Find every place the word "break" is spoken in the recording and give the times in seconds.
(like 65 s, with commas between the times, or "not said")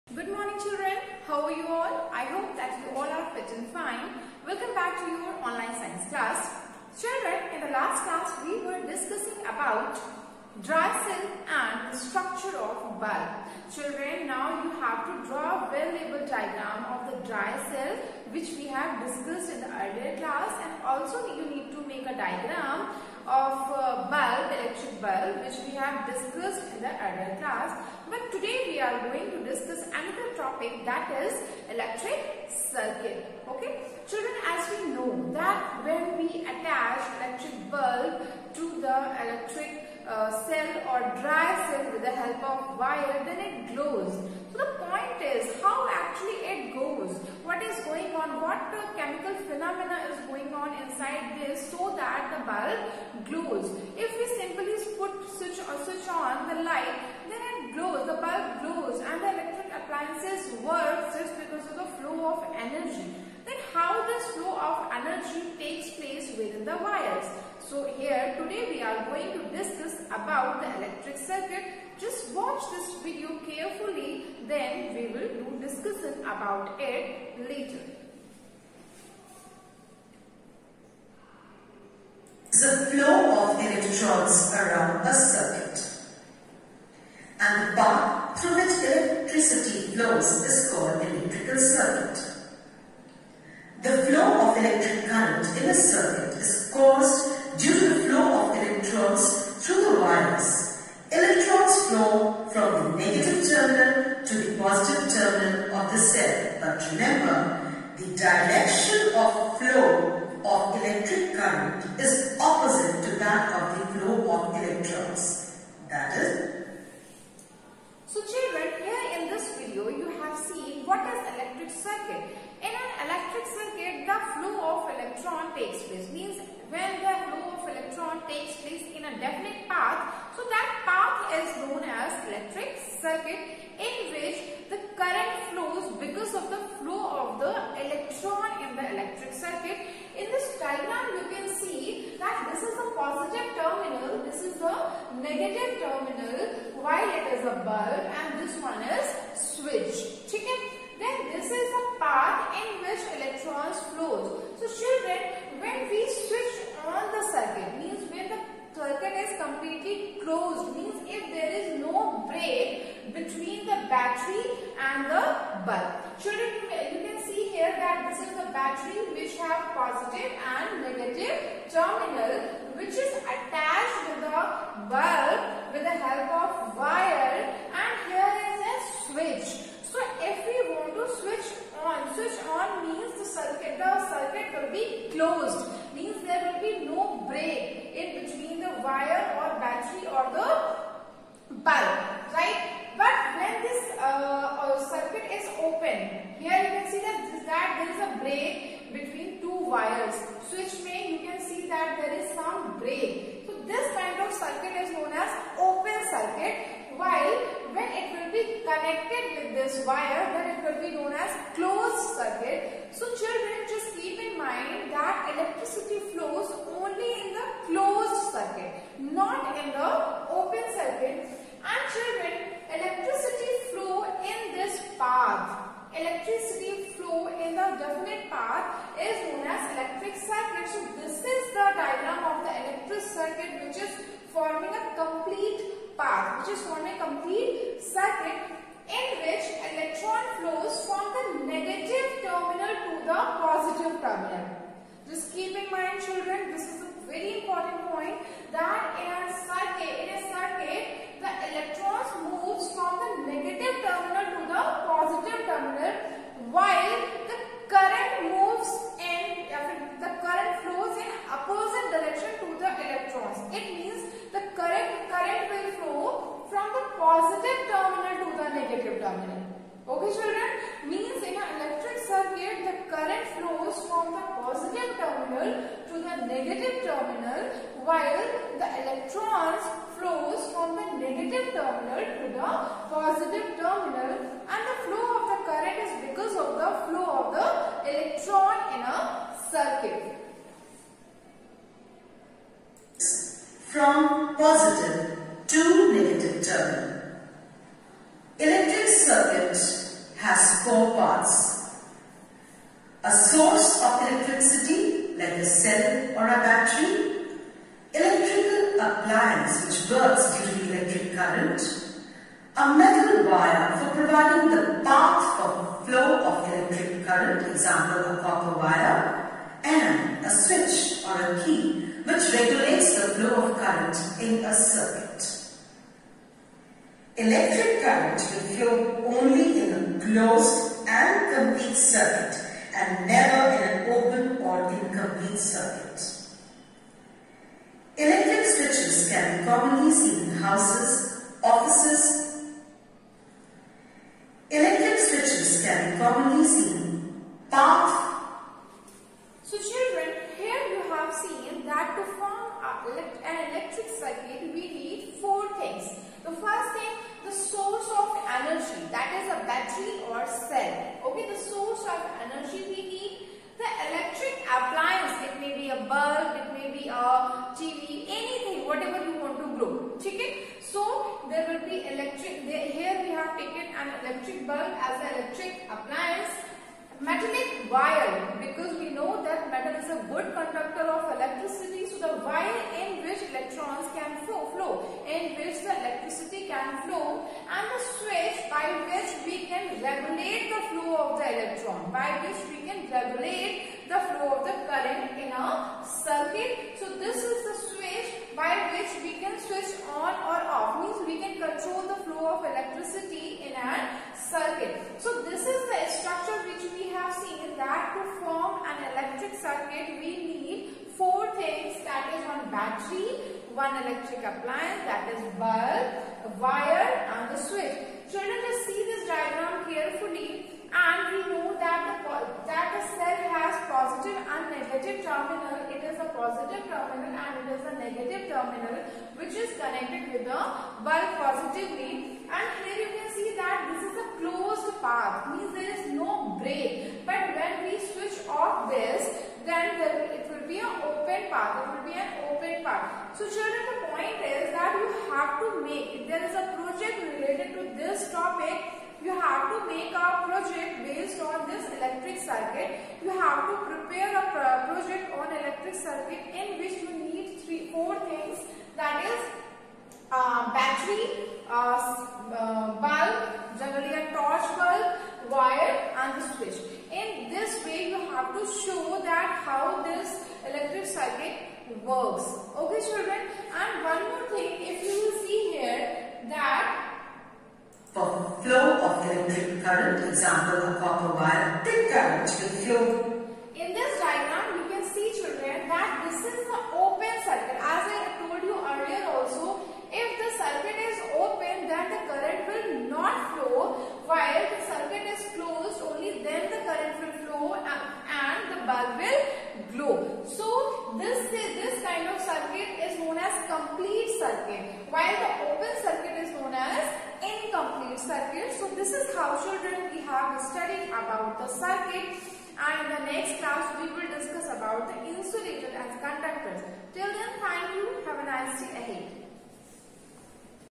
162 s, 198 s, 202 s, 436 s.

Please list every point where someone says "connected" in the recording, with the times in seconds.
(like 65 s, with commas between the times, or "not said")
208 s, 429 s.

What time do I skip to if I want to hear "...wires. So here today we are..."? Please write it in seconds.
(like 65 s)
66 s.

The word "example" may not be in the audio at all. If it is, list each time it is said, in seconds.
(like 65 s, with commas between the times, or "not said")
317 s, 480 s.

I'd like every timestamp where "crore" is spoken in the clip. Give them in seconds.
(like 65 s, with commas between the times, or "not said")
not said.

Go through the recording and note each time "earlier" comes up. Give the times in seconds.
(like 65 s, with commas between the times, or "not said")
19 s, 26 s.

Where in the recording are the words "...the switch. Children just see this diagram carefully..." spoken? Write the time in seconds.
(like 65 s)
417 s.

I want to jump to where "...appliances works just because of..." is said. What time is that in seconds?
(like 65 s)
59 s.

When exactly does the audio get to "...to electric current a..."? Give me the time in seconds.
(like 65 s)
310 s.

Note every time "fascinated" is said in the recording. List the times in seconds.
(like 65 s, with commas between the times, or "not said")
not said.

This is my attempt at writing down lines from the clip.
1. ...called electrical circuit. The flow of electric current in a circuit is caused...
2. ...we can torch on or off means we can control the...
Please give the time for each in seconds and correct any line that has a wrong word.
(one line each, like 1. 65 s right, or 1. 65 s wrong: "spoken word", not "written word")
1. 90 s right
2. 399 s wrong: "switch", not "torch".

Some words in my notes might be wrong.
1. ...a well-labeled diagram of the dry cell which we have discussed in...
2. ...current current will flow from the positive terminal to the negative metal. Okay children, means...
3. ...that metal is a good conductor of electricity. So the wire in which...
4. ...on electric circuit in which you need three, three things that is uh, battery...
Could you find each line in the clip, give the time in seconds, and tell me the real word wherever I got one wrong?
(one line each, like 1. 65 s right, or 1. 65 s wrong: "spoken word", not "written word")
1. 15 s right
2. 264 s wrong: "terminal", not "metal"
3. 379 s right
4. 455 s wrong: "four", not "three".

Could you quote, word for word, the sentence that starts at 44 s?
So the point is how actually it goes, what is going on, what so that the bulb glows.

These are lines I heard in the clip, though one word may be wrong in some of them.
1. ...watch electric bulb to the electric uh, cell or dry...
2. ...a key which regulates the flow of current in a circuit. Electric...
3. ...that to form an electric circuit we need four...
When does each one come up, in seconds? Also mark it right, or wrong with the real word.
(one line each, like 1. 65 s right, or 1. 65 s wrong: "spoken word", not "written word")
1. 36 s wrong: "attach", not "watch"
2. 321 s right
3. 407 s right.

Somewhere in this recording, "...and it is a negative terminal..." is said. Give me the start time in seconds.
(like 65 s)
427 s.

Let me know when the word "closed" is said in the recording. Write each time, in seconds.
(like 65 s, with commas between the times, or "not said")
160 s, 211 s, 330 s, 434 s.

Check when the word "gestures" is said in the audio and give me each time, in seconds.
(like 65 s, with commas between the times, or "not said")
not said.